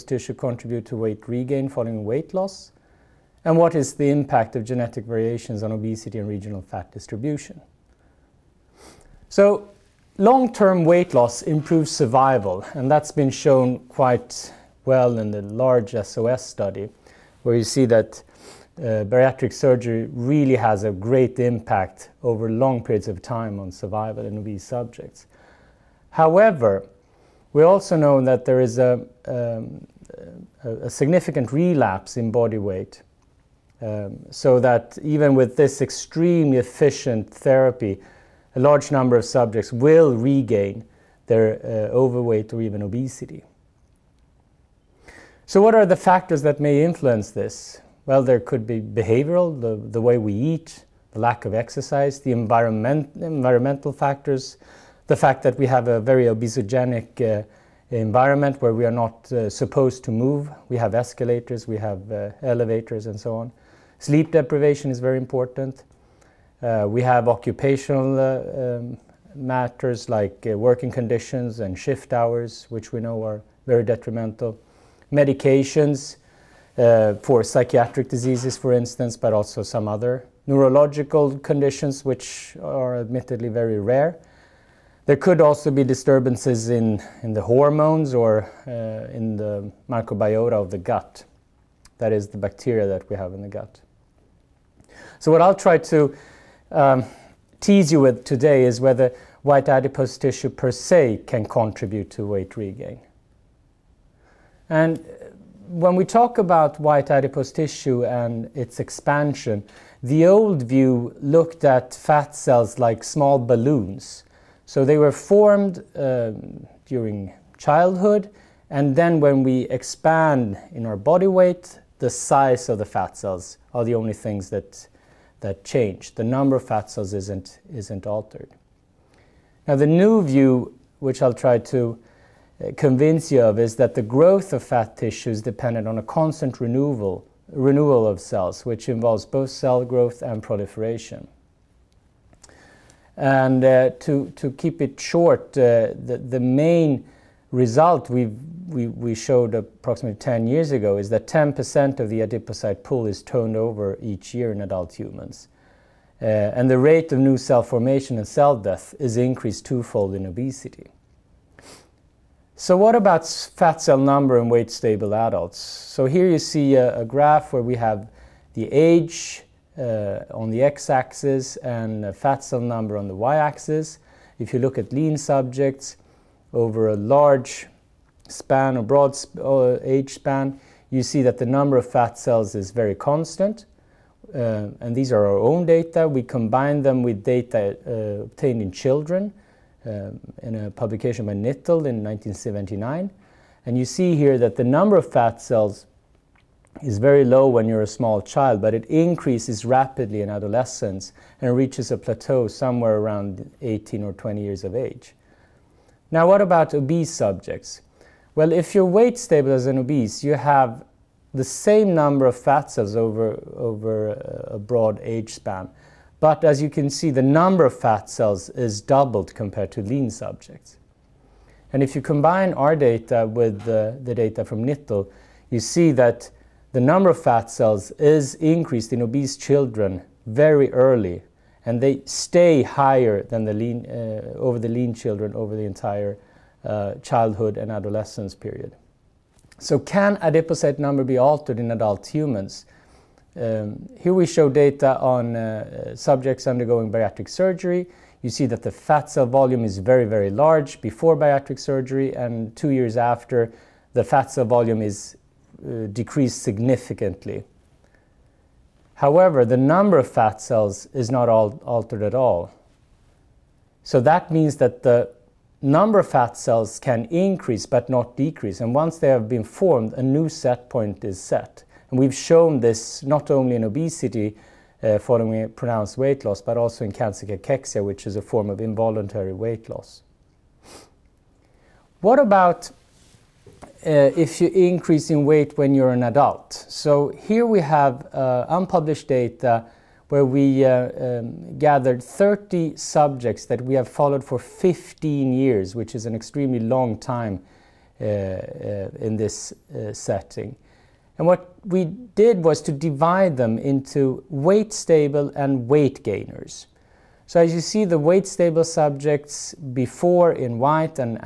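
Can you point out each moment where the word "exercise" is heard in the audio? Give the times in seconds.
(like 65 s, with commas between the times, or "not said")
51 s.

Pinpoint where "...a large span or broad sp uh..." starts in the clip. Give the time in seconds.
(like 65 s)
176 s.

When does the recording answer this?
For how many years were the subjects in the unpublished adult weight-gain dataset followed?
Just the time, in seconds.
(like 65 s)
294 s.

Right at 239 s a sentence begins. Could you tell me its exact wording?
So can adipocyte number be altered in adult humans?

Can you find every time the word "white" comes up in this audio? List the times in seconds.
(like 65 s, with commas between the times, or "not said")
99 s, 106 s, 310 s.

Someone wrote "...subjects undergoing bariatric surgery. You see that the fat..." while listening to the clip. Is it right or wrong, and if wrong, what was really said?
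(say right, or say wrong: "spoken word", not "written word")
right.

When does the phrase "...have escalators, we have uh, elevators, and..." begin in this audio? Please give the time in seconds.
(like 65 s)
60 s.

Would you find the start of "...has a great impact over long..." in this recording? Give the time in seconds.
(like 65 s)
20 s.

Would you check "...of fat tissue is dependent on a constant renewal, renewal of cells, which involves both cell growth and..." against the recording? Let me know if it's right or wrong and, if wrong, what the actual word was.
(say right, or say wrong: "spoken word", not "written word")
right.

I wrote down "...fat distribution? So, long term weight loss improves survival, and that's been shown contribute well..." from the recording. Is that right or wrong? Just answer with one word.
wrong.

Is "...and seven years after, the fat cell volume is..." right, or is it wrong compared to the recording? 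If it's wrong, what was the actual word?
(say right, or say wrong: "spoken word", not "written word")
wrong: "two", not "seven".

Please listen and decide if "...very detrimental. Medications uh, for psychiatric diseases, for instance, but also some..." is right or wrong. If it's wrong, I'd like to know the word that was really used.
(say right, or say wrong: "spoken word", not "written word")
right.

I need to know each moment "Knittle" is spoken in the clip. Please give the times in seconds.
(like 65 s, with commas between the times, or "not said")
191 s, 224 s.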